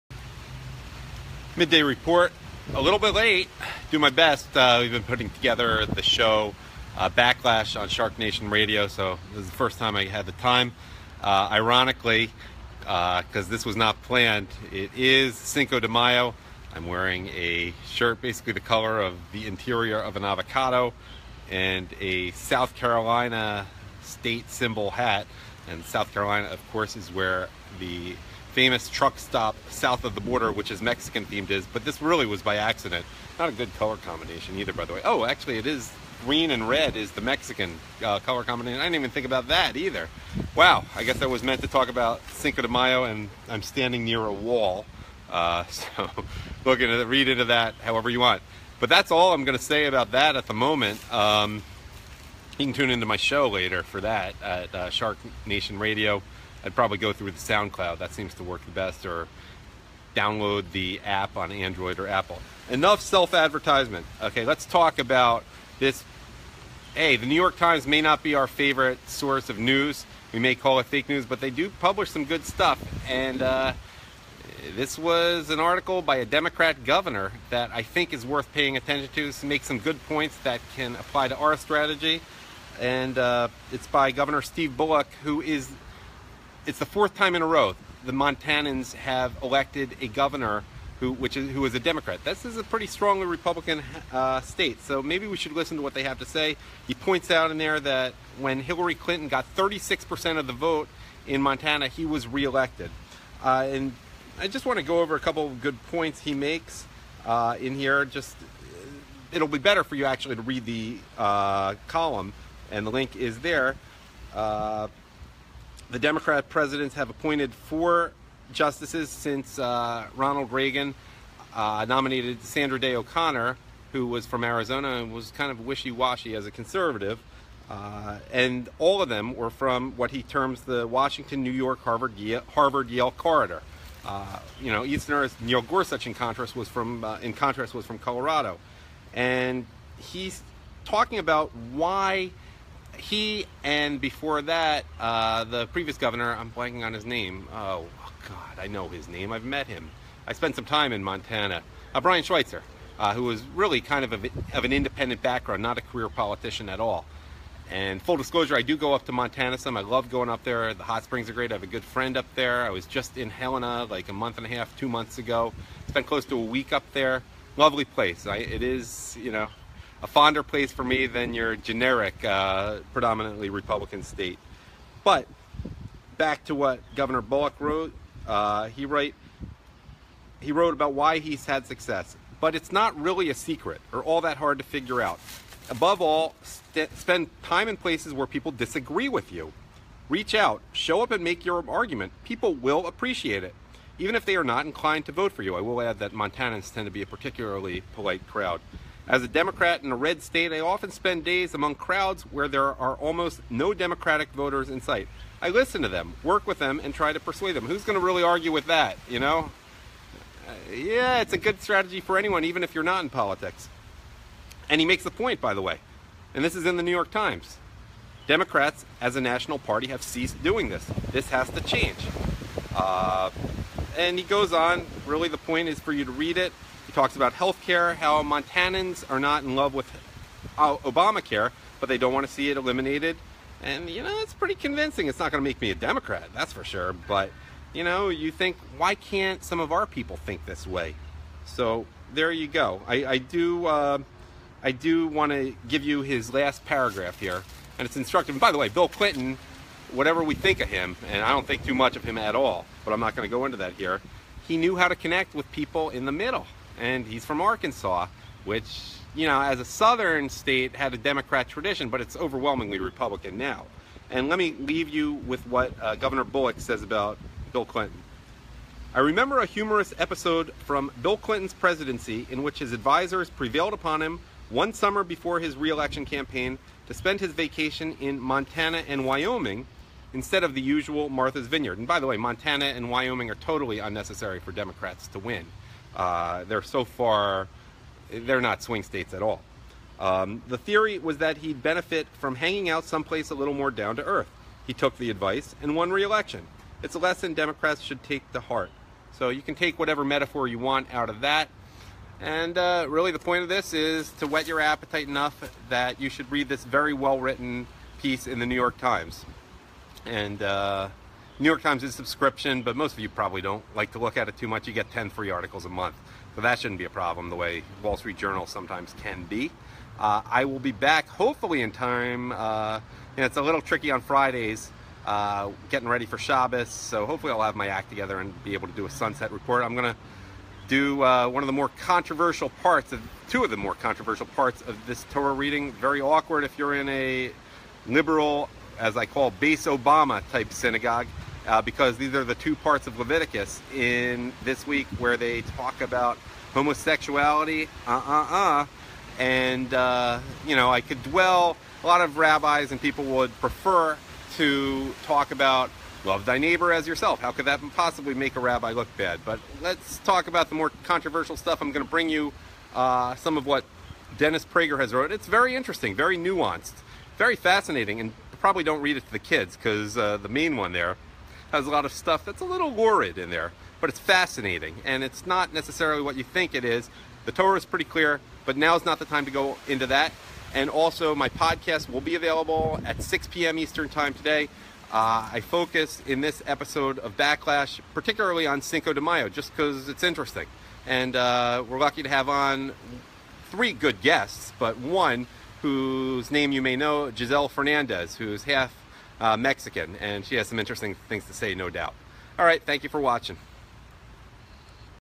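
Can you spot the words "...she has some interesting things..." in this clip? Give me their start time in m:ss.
6:40.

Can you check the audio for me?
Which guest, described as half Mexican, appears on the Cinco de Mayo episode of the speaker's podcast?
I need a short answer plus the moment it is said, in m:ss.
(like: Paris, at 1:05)
Giselle Fernandez, at 6:37.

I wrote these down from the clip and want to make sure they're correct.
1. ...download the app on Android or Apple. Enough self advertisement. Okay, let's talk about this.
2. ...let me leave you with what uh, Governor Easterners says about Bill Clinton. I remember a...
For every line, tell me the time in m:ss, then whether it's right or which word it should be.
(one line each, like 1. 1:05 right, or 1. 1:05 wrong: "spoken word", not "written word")
1. 1:00 right
2. 4:24 wrong: "Bullock", not "Easterners".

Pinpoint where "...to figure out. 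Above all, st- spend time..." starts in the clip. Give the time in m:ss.
3:04.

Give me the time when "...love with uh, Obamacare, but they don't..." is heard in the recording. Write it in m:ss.
3:49.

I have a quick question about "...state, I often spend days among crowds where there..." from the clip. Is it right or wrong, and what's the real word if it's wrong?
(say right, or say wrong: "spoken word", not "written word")
right.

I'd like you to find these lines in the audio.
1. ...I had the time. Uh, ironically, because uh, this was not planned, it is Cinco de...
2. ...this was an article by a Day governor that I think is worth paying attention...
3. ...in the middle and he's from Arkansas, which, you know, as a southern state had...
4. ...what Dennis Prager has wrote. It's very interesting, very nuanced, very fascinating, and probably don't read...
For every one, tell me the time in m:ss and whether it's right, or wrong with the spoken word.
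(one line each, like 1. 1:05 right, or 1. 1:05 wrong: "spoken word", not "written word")
1. 0:09 right
2. 1:14 wrong: "Democrat", not "Day"
3. 4:15 right
4. 6:03 right.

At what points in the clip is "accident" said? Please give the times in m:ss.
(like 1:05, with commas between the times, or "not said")
0:32.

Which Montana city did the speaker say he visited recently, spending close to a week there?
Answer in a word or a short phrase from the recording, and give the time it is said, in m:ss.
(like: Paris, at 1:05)
Helena, at 2:43.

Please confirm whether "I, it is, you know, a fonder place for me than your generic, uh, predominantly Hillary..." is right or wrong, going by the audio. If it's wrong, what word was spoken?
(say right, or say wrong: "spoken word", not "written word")
wrong: "Republican", not "Hillary".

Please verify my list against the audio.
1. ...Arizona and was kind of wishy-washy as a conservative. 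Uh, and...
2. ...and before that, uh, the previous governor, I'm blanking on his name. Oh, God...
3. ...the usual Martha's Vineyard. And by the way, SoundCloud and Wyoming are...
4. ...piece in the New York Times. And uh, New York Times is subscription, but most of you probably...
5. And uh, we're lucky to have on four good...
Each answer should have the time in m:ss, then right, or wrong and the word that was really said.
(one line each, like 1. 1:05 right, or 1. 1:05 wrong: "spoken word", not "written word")
1. 2:04 right
2. 2:23 right
3. 4:40 wrong: "Montana", not "SoundCloud"
4. 5:08 right
5. 6:30 wrong: "three", not "four".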